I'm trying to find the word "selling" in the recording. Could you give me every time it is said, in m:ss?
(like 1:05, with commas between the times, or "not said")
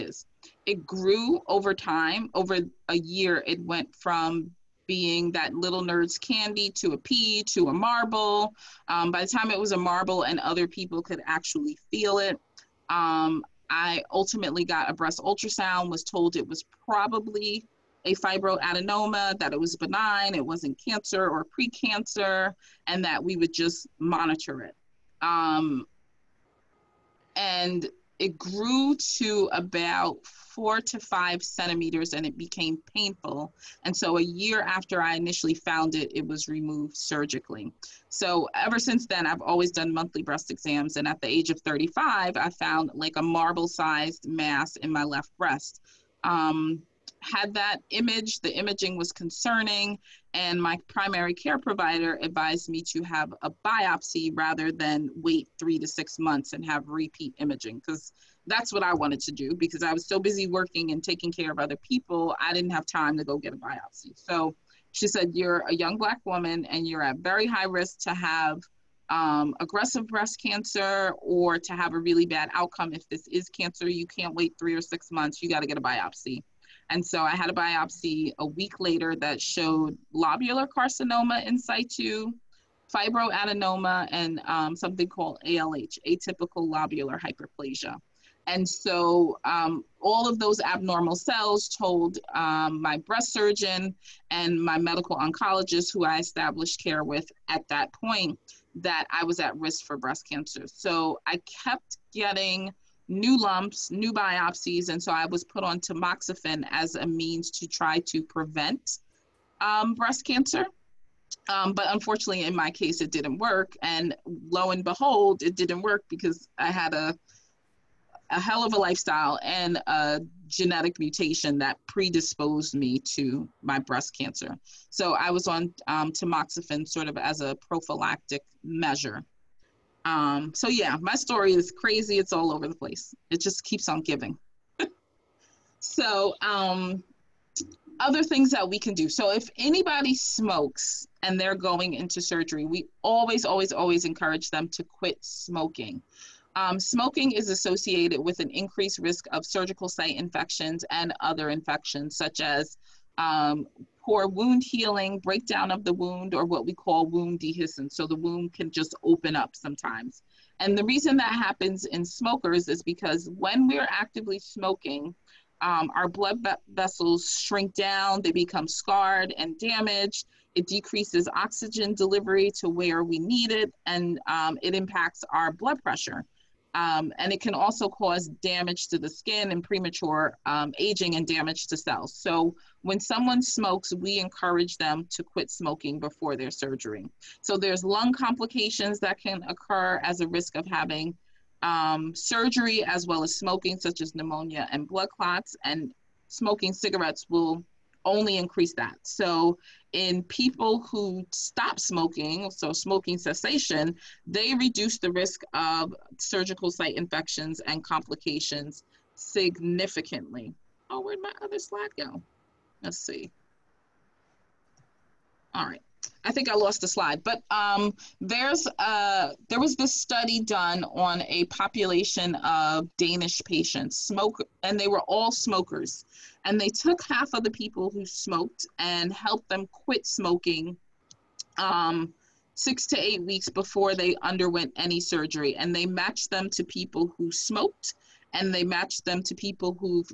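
not said.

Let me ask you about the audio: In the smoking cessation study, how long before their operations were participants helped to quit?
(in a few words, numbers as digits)
6 to 8 weeks.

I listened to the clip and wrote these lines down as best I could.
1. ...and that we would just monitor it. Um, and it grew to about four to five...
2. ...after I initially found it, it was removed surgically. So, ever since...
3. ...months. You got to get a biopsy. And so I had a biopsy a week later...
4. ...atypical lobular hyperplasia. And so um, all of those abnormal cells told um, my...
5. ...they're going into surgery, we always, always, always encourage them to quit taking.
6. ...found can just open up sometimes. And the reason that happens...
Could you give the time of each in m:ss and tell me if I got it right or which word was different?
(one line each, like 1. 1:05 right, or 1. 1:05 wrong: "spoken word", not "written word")
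1. 0:22 right
2. 0:34 right
3. 1:15 right
4. 1:26 right
5. 2:21 wrong: "smoking", not "taking"
6. 2:38 wrong: "wound", not "found".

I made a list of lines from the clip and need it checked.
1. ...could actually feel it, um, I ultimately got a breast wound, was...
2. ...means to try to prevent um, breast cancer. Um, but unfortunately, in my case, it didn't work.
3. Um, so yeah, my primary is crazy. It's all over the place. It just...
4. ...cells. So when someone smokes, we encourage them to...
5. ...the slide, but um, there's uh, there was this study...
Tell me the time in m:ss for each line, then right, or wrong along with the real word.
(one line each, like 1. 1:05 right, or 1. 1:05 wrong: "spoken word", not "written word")
1. 0:11 wrong: "ultrasound", not "wound"
2. 1:47 right
3. 2:10 wrong: "story", not "primary"
4. 3:01 right
5. 3:36 right.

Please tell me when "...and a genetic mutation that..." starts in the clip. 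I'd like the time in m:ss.
1:59.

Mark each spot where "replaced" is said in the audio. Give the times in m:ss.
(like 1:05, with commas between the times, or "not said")
not said.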